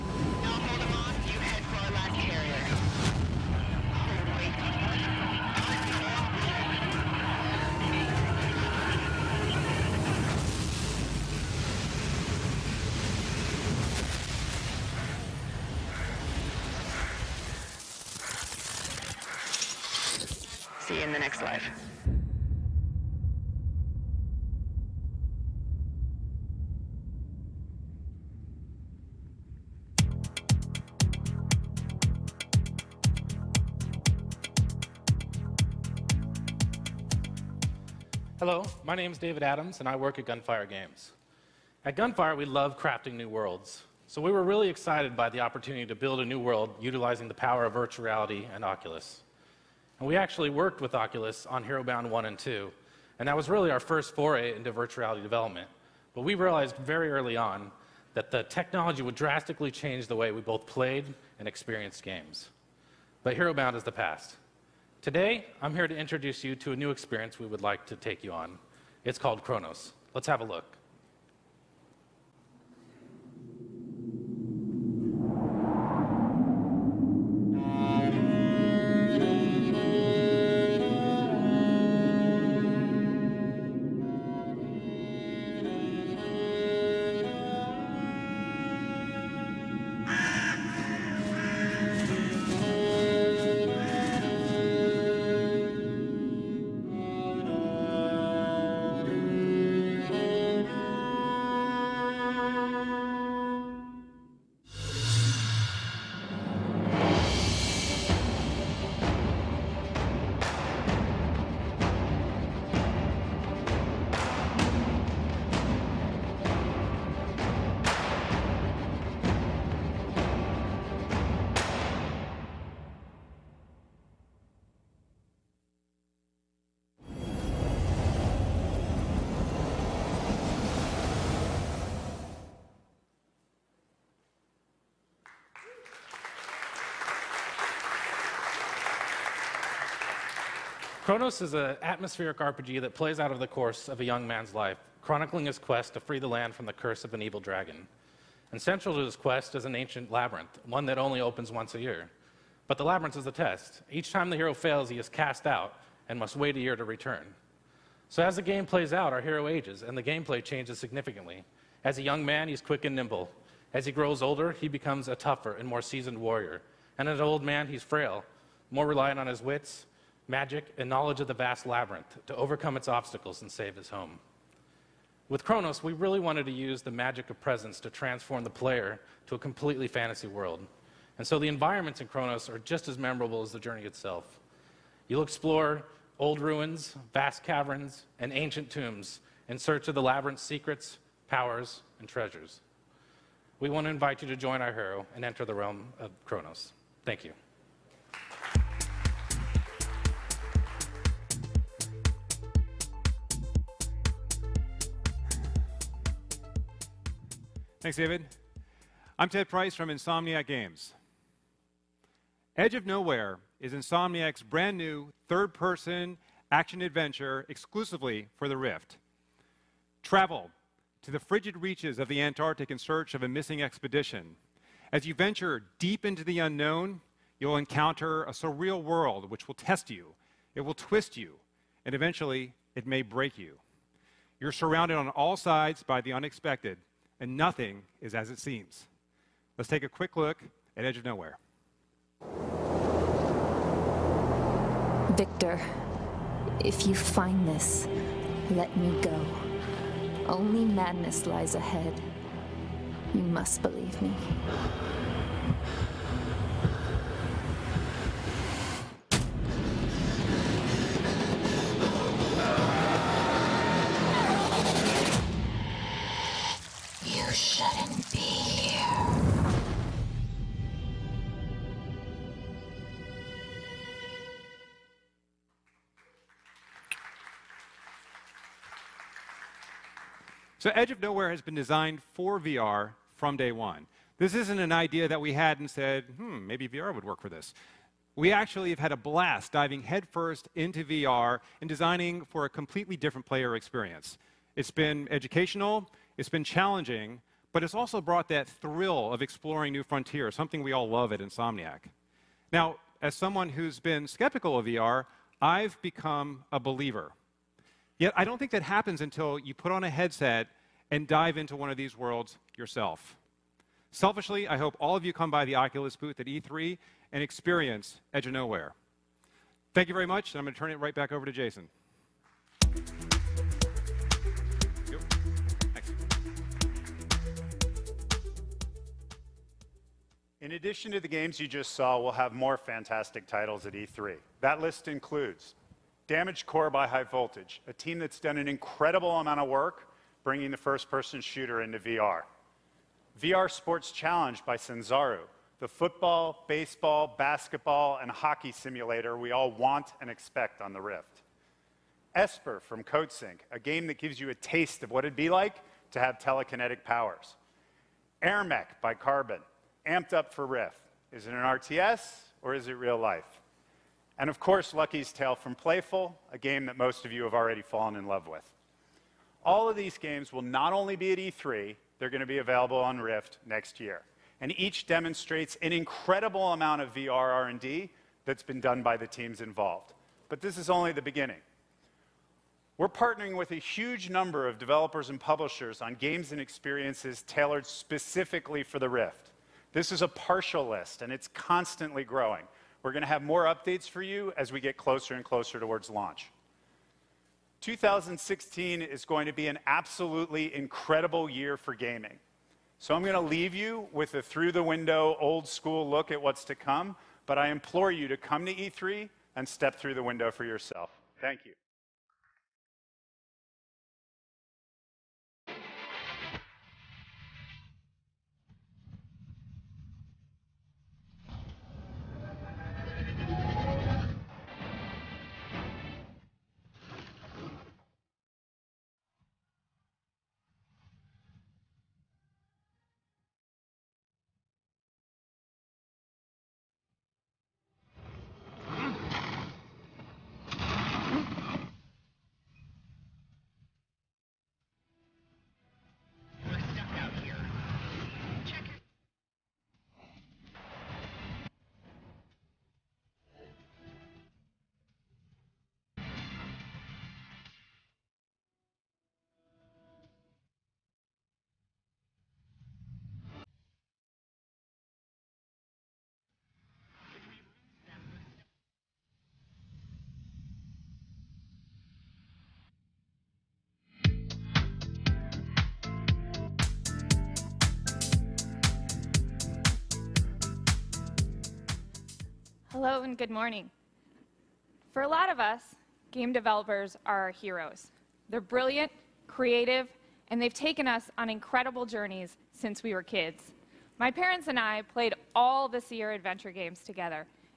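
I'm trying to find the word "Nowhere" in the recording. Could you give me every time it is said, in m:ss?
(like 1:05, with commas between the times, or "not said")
3:32, 4:01, 4:40, 5:18.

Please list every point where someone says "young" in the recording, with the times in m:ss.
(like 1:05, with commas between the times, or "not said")
2:24, 2:42.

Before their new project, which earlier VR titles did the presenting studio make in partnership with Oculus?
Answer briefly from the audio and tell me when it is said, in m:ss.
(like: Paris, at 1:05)
Herobound 1 and 2, at 0:51.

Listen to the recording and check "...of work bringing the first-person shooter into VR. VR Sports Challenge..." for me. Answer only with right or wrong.
right.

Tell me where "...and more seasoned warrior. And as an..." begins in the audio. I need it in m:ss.
2:45.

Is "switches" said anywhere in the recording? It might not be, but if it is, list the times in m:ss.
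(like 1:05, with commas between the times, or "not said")
not said.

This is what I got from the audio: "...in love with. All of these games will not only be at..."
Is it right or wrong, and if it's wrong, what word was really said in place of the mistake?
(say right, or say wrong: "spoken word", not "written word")
right.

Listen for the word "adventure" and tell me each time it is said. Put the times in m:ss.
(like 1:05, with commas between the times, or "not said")
3:36, 8:16.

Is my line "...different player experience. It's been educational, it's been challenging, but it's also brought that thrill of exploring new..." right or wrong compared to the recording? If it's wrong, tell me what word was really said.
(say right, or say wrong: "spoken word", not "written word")
right.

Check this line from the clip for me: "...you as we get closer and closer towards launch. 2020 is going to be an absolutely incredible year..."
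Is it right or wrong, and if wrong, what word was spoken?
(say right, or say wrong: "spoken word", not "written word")
wrong: "2016", not "2020".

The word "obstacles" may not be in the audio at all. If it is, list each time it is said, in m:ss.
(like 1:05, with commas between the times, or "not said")
2:52.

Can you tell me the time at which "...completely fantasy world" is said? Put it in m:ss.
2:59.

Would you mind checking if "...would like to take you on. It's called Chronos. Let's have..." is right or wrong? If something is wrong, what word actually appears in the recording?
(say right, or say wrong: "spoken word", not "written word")
right.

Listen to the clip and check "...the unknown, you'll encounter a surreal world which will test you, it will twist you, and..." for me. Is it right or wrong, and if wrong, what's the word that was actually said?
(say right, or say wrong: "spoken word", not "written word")
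right.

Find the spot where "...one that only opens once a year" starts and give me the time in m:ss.
2:30.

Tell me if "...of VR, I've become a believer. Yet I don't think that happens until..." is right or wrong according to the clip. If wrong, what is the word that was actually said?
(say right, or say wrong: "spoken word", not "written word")
right.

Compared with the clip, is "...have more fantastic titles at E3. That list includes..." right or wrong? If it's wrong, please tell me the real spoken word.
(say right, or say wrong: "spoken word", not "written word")
right.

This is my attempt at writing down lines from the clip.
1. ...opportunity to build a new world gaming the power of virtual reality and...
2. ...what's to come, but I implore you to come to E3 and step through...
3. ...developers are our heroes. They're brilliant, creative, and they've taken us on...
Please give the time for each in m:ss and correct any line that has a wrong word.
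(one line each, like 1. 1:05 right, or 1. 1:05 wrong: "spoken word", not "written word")
1. 0:45 wrong: "utilizing", not "gaming"
2. 6:46 right
3. 8:06 right.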